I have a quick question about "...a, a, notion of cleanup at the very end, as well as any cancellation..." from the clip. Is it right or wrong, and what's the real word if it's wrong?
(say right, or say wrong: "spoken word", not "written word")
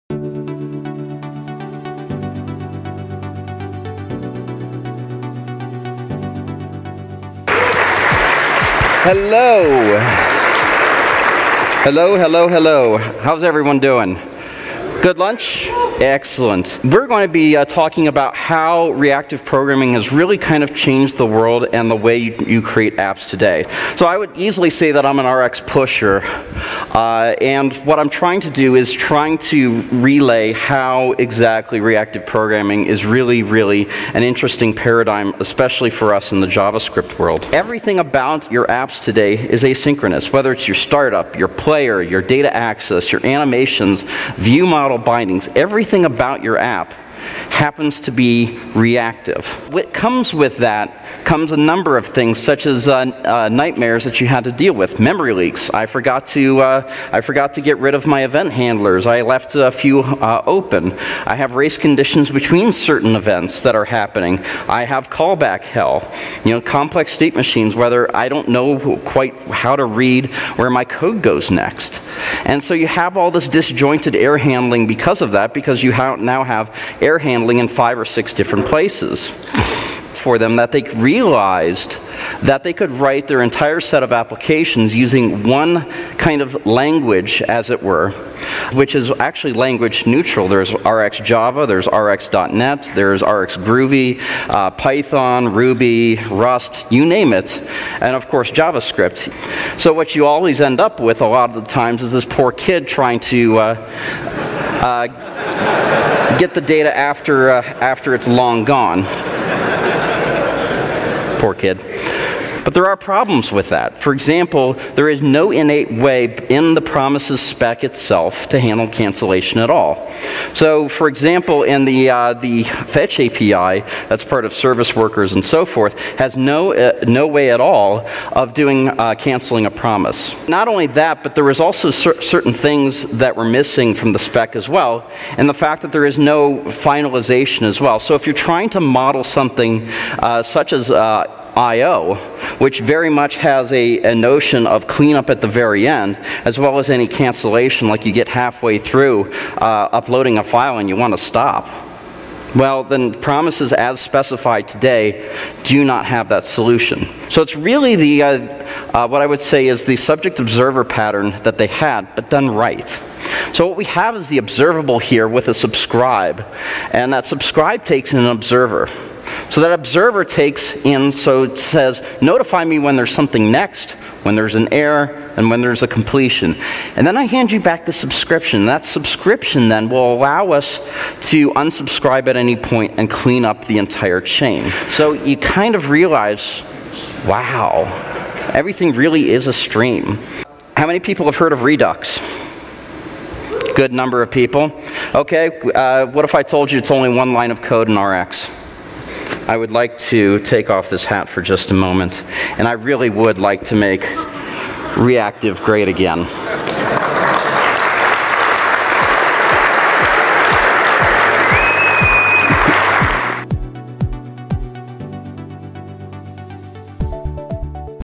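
right.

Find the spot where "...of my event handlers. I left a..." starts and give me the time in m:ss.
0:57.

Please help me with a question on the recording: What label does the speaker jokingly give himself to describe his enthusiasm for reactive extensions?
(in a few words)
RX pusher.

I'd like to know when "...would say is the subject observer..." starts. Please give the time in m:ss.
2:39.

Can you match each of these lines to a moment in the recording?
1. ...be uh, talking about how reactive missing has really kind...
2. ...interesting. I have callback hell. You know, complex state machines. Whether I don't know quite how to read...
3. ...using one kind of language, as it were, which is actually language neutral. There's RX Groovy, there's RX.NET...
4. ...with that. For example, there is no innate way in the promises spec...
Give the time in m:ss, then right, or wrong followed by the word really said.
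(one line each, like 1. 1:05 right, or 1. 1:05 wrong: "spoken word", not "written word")
1. 0:17 wrong: "programming", not "missing"
2. 1:03 wrong: "happening", not "interesting"
3. 1:24 wrong: "Java", not "Groovy"
4. 1:53 right.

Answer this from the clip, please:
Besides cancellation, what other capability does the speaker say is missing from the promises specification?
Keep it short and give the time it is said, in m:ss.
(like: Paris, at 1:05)
finalization, at 2:16.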